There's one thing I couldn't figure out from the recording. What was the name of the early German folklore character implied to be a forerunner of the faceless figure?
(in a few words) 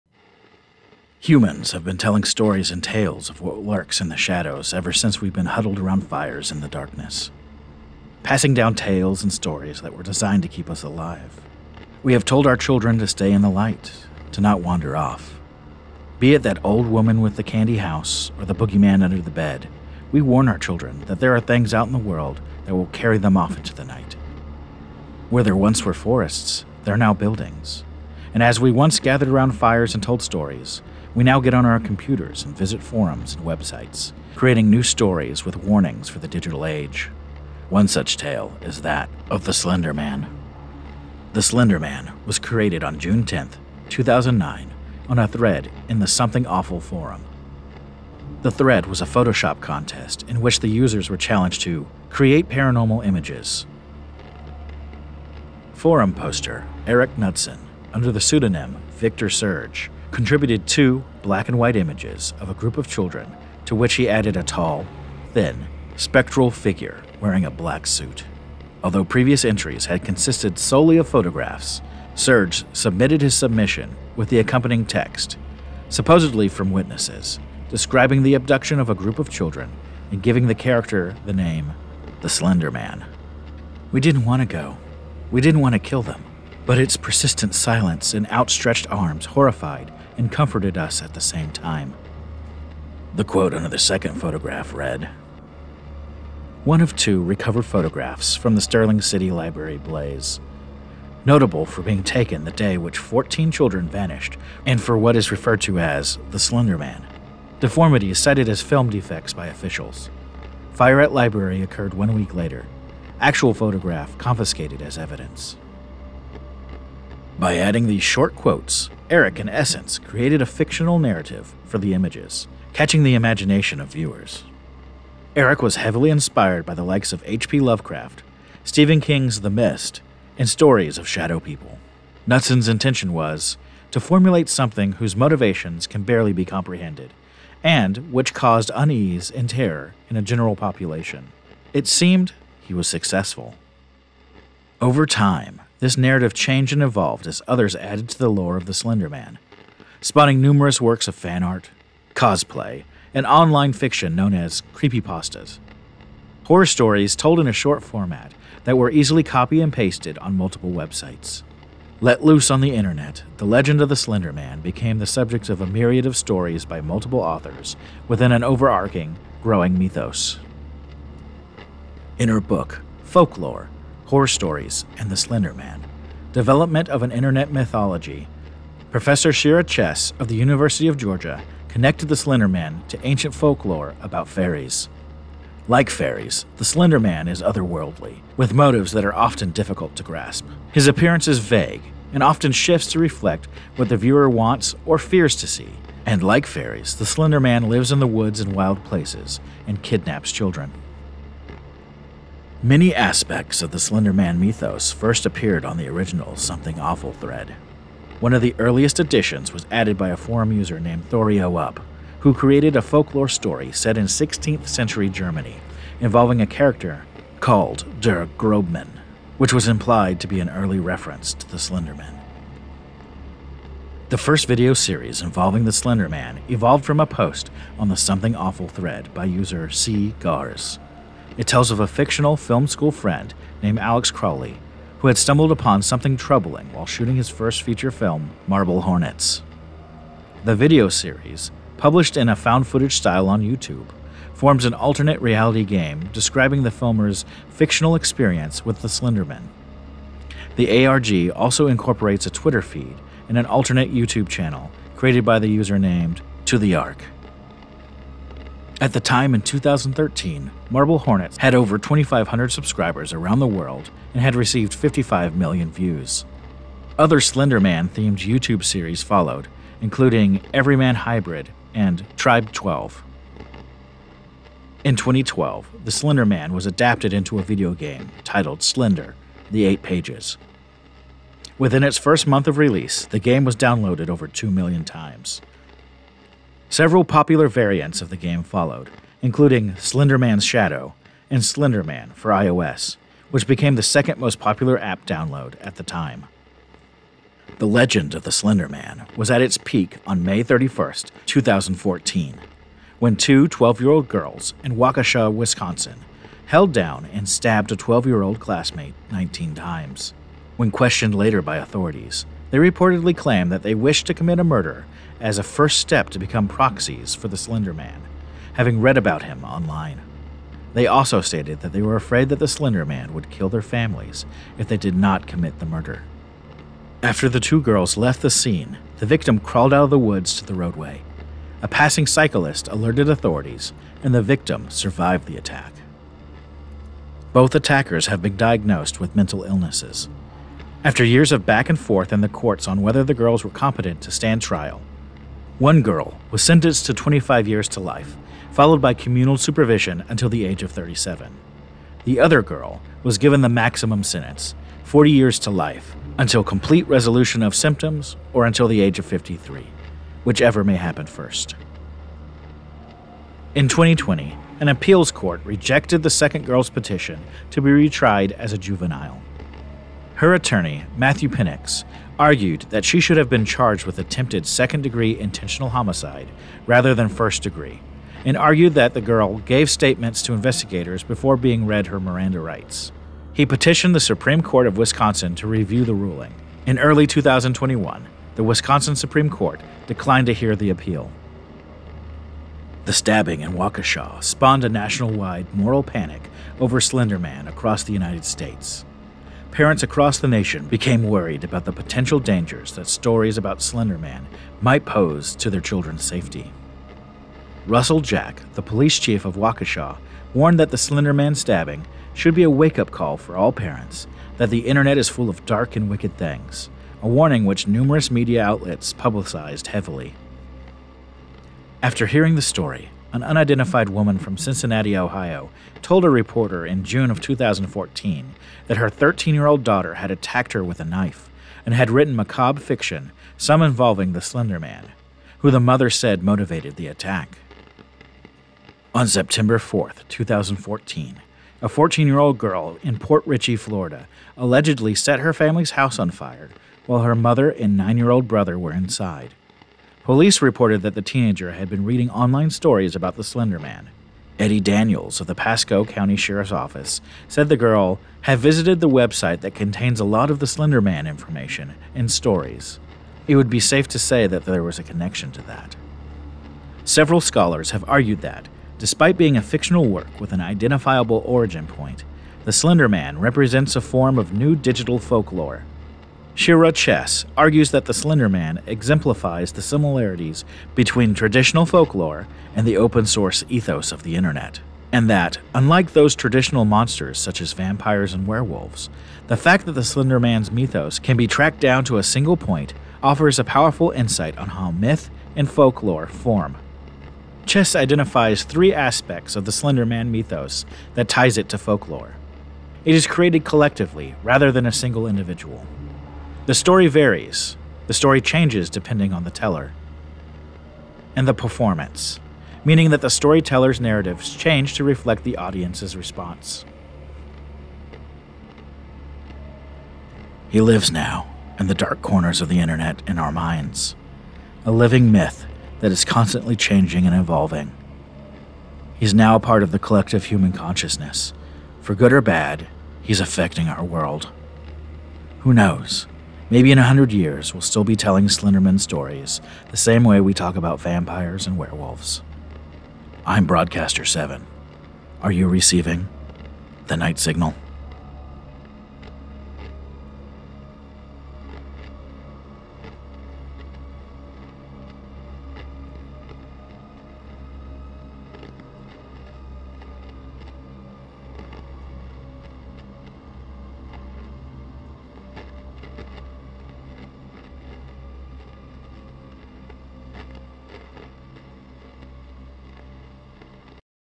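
Der Grobman.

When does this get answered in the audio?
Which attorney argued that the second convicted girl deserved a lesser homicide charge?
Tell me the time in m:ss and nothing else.
6:10.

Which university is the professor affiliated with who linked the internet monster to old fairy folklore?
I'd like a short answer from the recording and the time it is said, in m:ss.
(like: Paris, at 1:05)
University of Georgia, at 3:00.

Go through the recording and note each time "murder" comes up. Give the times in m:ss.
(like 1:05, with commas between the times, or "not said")
5:14, 5:25.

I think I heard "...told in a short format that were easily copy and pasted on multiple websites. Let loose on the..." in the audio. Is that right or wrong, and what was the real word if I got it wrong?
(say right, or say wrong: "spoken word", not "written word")
right.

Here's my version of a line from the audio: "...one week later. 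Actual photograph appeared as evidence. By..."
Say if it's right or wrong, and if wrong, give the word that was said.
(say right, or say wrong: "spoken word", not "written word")
wrong: "confiscated", not "appeared".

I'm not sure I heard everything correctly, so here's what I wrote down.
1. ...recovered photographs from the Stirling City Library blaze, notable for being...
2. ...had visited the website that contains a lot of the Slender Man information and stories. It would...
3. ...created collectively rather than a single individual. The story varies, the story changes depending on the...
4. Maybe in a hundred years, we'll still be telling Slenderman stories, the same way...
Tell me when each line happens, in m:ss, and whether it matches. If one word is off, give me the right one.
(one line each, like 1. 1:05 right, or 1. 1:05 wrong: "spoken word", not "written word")
1. 1:37 right
2. 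7:38 right
3. 8:23 right
4. 8:56 right.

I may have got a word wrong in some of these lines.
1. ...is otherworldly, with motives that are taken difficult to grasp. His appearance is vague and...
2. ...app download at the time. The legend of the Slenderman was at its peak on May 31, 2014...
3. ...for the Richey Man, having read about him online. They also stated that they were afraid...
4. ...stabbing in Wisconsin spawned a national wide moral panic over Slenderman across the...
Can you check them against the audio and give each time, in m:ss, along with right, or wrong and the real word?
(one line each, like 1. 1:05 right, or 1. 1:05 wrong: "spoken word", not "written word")
1. 3:07 wrong: "often", not "taken"
2. 4:54 right
3. 5:17 wrong: "Slender", not "Richey"
4. 6:32 wrong: "Waukesha", not "Wisconsin".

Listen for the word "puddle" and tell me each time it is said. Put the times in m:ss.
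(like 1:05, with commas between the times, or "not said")
not said.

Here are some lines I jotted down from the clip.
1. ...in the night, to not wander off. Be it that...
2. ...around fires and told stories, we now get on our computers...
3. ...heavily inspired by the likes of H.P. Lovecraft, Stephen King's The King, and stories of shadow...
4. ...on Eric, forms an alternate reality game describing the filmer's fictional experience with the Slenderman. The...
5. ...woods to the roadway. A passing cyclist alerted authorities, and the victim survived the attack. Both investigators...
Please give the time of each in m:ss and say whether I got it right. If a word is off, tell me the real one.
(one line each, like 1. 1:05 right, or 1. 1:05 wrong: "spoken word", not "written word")
1. 0:13 wrong: "light", not "night"
2. 0:29 right
3. 2:05 wrong: "Mist", not "King"
4. 4:03 wrong: "YouTube", not "Eric"
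5. 5:29 wrong: "attackers", not "investigators".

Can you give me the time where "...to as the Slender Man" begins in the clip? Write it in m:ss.
1:45.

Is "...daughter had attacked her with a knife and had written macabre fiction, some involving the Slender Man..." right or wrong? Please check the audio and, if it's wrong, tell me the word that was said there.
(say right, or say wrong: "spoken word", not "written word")
right.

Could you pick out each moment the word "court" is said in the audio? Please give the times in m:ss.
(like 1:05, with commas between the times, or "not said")
5:42, 6:05, 6:24, 6:29.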